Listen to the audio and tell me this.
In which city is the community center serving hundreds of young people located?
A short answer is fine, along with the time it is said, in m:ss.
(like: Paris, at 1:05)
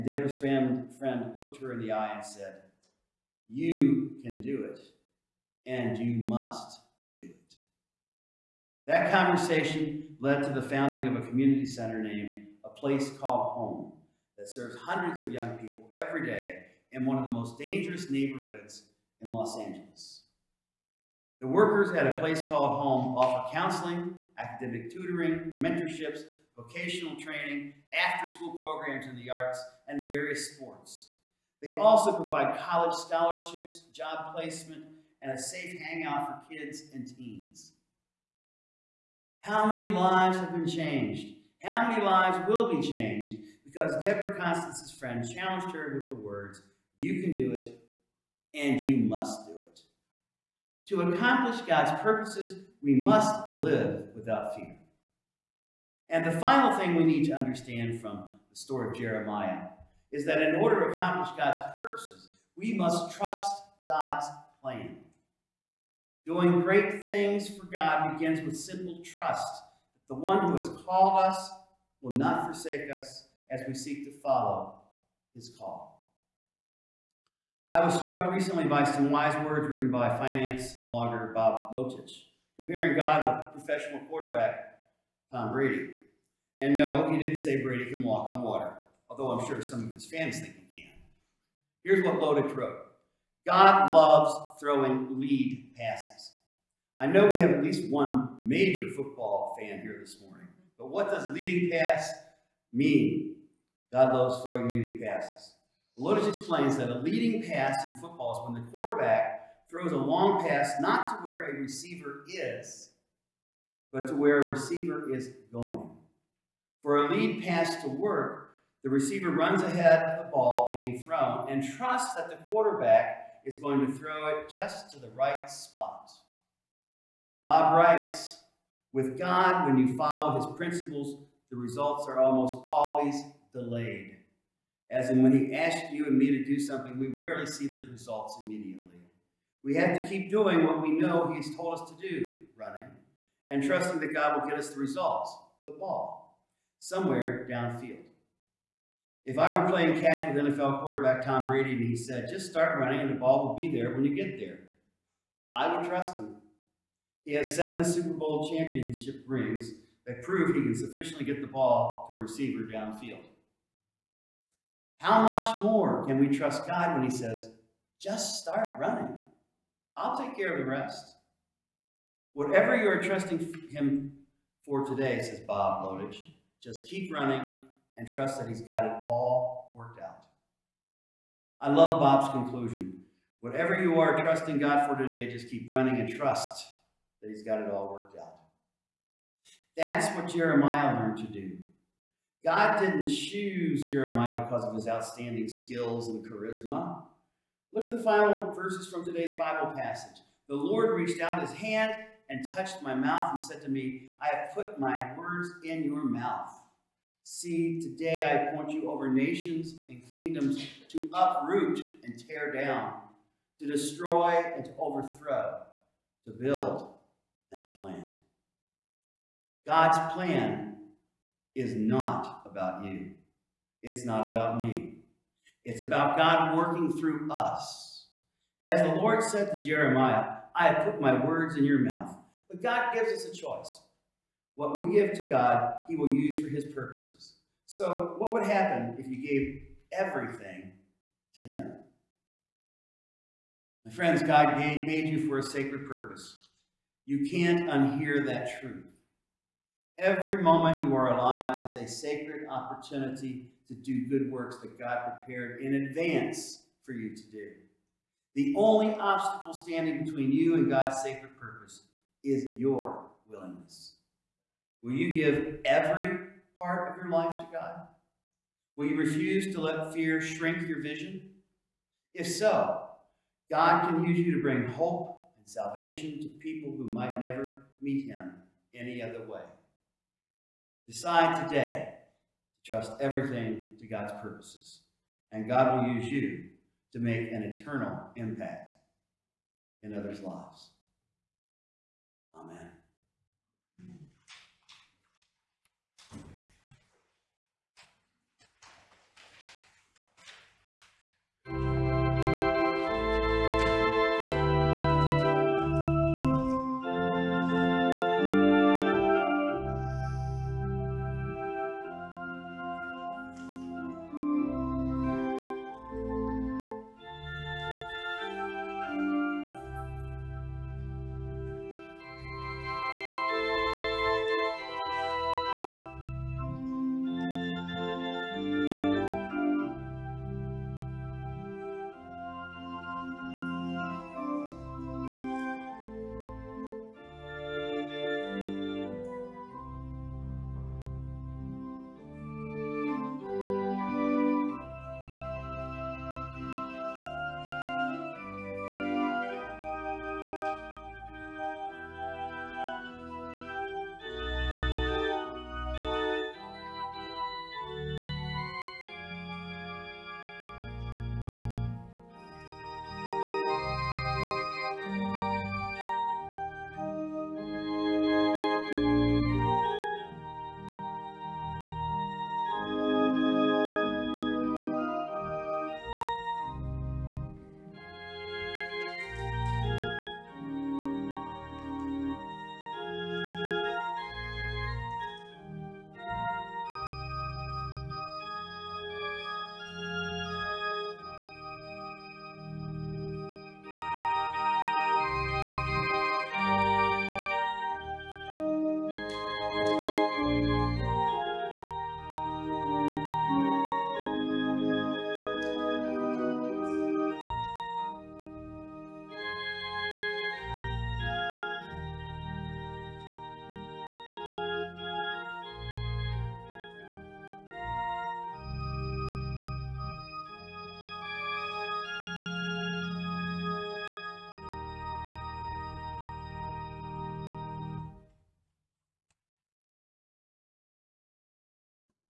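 Los Angeles, at 0:19.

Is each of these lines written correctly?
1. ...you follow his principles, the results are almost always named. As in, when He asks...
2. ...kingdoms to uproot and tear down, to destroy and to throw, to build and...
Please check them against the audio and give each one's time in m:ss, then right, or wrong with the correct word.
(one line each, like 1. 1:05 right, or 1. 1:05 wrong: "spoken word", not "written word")
1. 2:09 wrong: "delayed", not "named"
2. 3:30 wrong: "overthrow", not "throw".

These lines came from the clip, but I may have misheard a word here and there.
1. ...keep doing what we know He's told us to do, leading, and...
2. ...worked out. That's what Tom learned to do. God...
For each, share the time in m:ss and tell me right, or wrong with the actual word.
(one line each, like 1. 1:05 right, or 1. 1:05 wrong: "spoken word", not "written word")
1. 2:20 wrong: "running", not "leading"
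2. 3:07 wrong: "Jeremiah", not "Tom".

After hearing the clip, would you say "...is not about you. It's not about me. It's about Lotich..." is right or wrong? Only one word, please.
wrong.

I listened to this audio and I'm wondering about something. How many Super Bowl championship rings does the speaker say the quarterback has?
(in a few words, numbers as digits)
7.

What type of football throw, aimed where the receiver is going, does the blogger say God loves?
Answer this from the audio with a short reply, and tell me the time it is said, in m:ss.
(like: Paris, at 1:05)
Lead passes, at 1:35.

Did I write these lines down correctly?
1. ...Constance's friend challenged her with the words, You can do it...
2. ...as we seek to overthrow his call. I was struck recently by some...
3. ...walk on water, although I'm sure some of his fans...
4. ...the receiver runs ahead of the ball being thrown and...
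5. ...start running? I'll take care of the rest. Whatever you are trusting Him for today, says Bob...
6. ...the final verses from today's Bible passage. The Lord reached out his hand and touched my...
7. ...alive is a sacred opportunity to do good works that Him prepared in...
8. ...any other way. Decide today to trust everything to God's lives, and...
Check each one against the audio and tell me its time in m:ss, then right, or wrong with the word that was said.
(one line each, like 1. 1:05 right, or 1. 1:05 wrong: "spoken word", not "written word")
1. 0:44 right
2. 1:13 wrong: "follow", not "overthrow"
3. 1:28 right
4. 1:58 right
5. 2:48 right
6. 3:17 right
7. 4:11 wrong: "God", not "Him"
8. 4:38 wrong: "purposes", not "lives".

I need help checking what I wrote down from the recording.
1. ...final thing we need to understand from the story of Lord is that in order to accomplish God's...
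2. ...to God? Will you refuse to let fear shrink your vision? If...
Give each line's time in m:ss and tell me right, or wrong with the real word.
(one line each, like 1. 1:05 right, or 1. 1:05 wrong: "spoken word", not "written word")
1. 0:56 wrong: "Jeremiah", not "Lord"
2. 4:27 right.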